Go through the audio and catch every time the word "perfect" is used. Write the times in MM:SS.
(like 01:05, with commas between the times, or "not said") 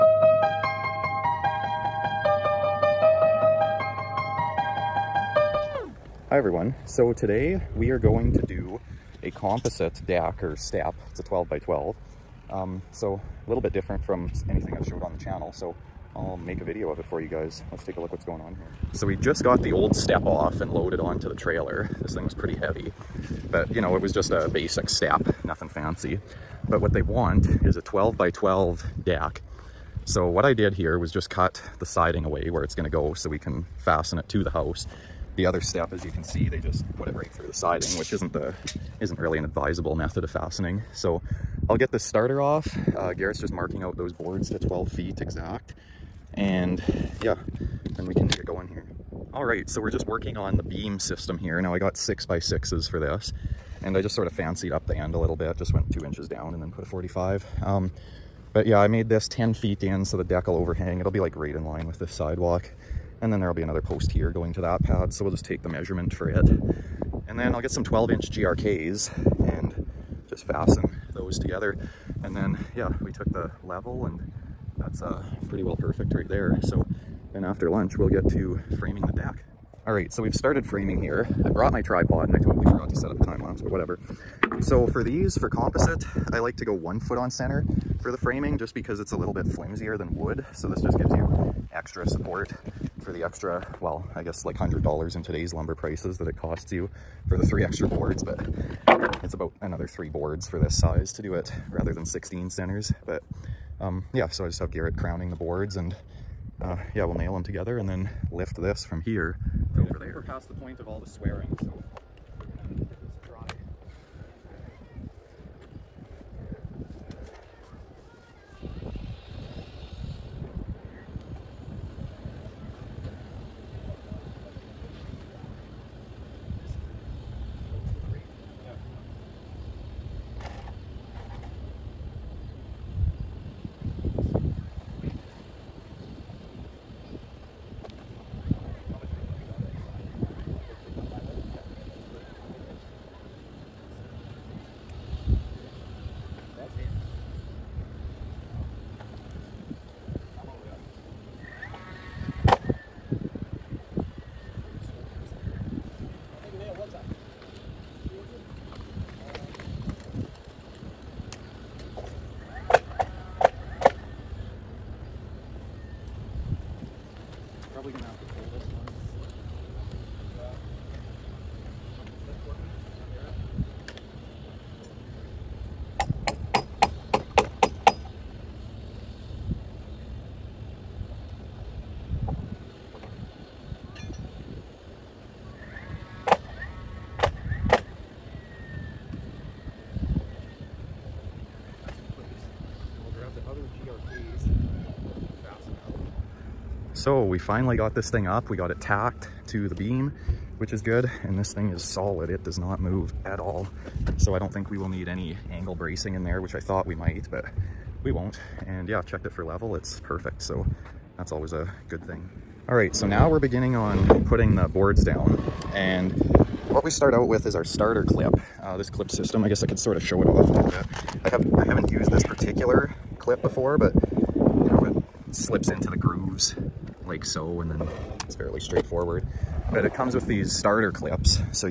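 01:15, 03:30.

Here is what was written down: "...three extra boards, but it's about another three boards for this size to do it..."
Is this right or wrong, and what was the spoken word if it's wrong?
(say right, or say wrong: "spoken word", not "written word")
right.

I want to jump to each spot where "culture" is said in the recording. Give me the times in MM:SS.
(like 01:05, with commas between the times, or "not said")
not said.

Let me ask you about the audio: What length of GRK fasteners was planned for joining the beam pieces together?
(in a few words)
12 inch.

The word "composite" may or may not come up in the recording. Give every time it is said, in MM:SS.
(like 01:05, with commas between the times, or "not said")
00:09, 01:25.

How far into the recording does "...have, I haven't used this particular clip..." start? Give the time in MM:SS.
03:41.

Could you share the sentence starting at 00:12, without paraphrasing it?
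Um, so a little bit different from anything I've showed on the channel.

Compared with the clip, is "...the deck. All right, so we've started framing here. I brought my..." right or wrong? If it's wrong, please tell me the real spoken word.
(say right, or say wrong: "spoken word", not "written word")
right.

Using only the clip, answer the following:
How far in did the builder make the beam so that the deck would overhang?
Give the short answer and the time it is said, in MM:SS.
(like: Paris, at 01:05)
10 feet, at 00:59.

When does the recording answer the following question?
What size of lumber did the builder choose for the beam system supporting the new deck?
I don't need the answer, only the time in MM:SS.
00:51.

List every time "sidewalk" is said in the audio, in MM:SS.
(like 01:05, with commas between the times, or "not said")
01:02.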